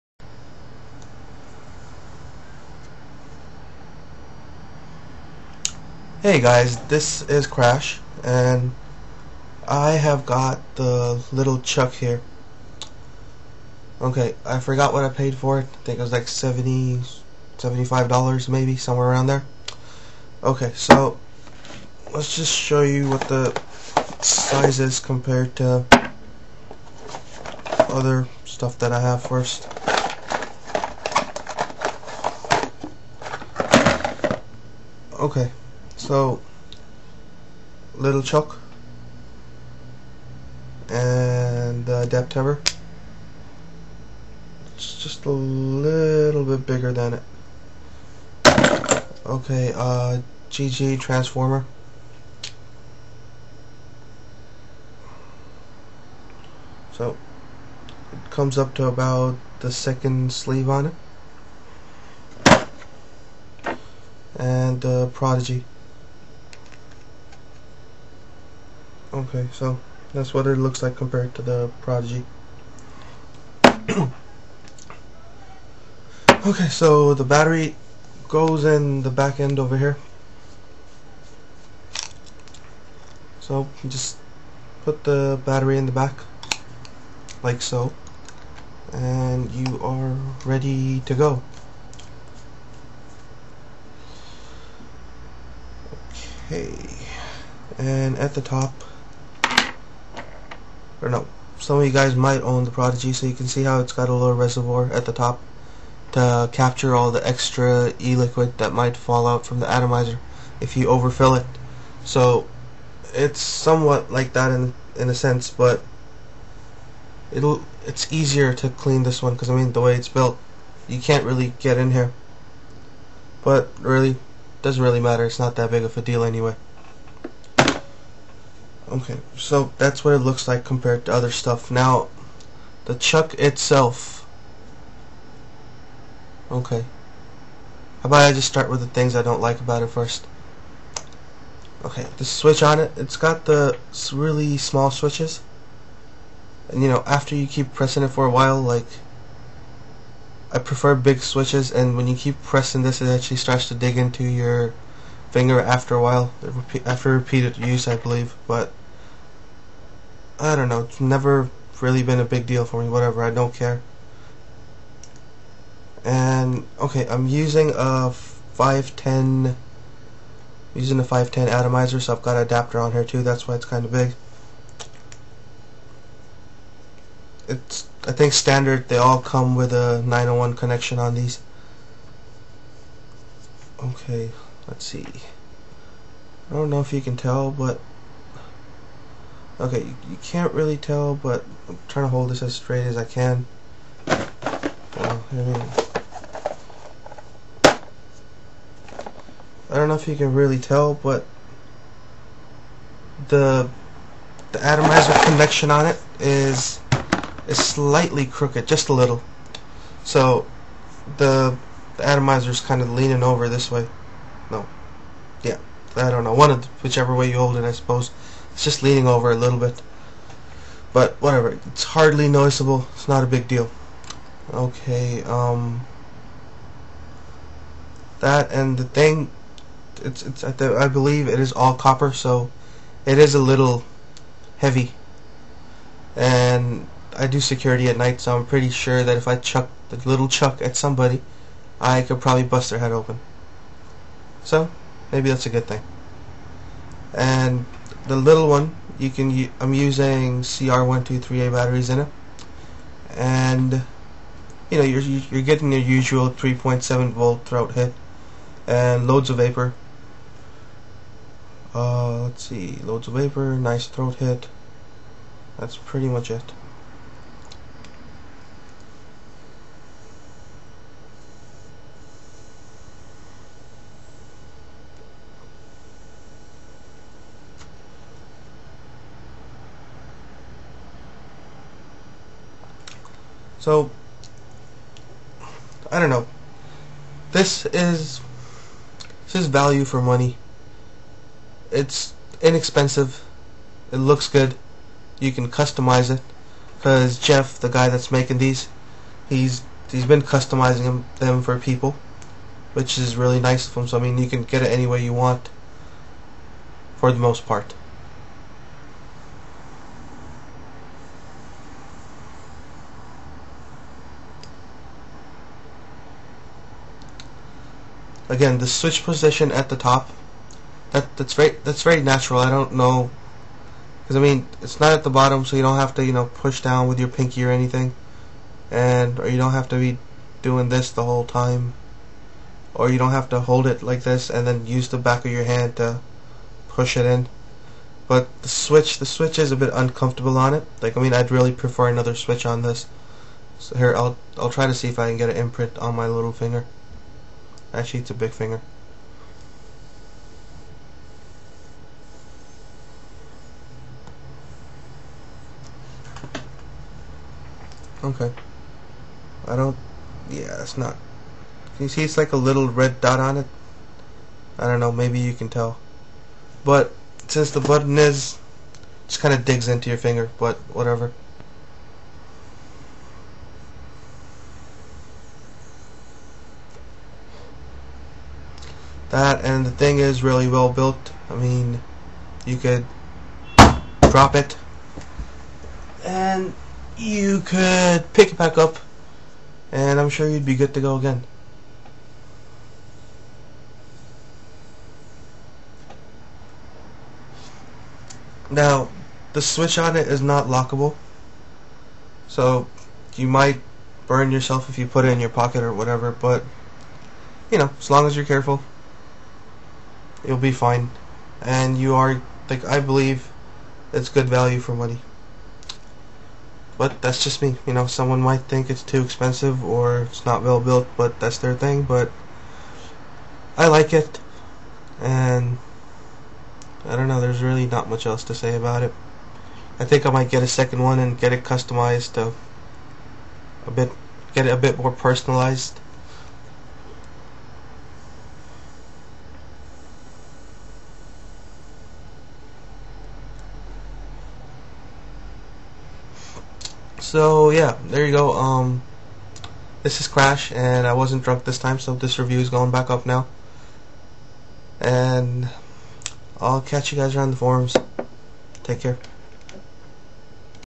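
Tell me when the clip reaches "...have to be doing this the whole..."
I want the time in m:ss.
5:29.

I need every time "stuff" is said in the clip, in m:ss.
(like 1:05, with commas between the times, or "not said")
0:28, 2:11.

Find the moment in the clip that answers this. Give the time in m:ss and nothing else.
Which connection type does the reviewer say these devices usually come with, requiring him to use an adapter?
3:00.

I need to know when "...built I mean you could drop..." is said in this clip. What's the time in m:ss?
6:20.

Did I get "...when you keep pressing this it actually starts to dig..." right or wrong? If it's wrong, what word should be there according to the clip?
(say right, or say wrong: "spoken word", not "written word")
right.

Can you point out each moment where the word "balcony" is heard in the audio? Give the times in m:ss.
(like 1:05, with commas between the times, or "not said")
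not said.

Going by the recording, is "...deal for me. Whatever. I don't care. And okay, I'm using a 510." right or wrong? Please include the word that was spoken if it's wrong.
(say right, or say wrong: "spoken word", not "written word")
right.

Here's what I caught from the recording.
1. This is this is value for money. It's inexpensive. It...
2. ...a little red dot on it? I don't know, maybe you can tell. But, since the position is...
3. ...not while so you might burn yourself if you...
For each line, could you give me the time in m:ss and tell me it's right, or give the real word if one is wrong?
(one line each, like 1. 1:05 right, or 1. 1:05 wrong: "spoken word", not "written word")
1. 4:47 right
2. 6:02 wrong: "button", not "position"
3. 6:40 wrong: "lockable", not "while".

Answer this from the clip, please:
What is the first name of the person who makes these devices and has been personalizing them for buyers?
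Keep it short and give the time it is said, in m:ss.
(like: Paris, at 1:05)
Jeff, at 4:57.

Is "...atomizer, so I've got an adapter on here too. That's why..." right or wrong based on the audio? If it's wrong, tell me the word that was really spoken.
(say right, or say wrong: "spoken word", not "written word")
right.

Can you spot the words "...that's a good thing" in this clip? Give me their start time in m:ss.
4:05.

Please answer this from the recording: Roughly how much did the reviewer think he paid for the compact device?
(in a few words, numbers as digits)
$75.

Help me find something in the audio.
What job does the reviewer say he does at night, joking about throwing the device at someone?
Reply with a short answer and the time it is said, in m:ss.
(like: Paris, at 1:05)
security, at 3:57.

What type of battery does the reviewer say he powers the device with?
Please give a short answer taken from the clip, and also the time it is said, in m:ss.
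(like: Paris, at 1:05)
CR123A, at 4:10.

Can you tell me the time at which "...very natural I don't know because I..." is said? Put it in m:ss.
5:21.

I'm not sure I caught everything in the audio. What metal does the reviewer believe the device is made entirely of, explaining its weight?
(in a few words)
copper.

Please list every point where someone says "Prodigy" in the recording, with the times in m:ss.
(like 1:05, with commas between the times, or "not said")
1:05, 1:11, 1:42.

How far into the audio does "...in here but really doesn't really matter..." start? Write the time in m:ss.
2:01.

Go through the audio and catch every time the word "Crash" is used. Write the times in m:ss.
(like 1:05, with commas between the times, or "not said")
0:07, 7:30.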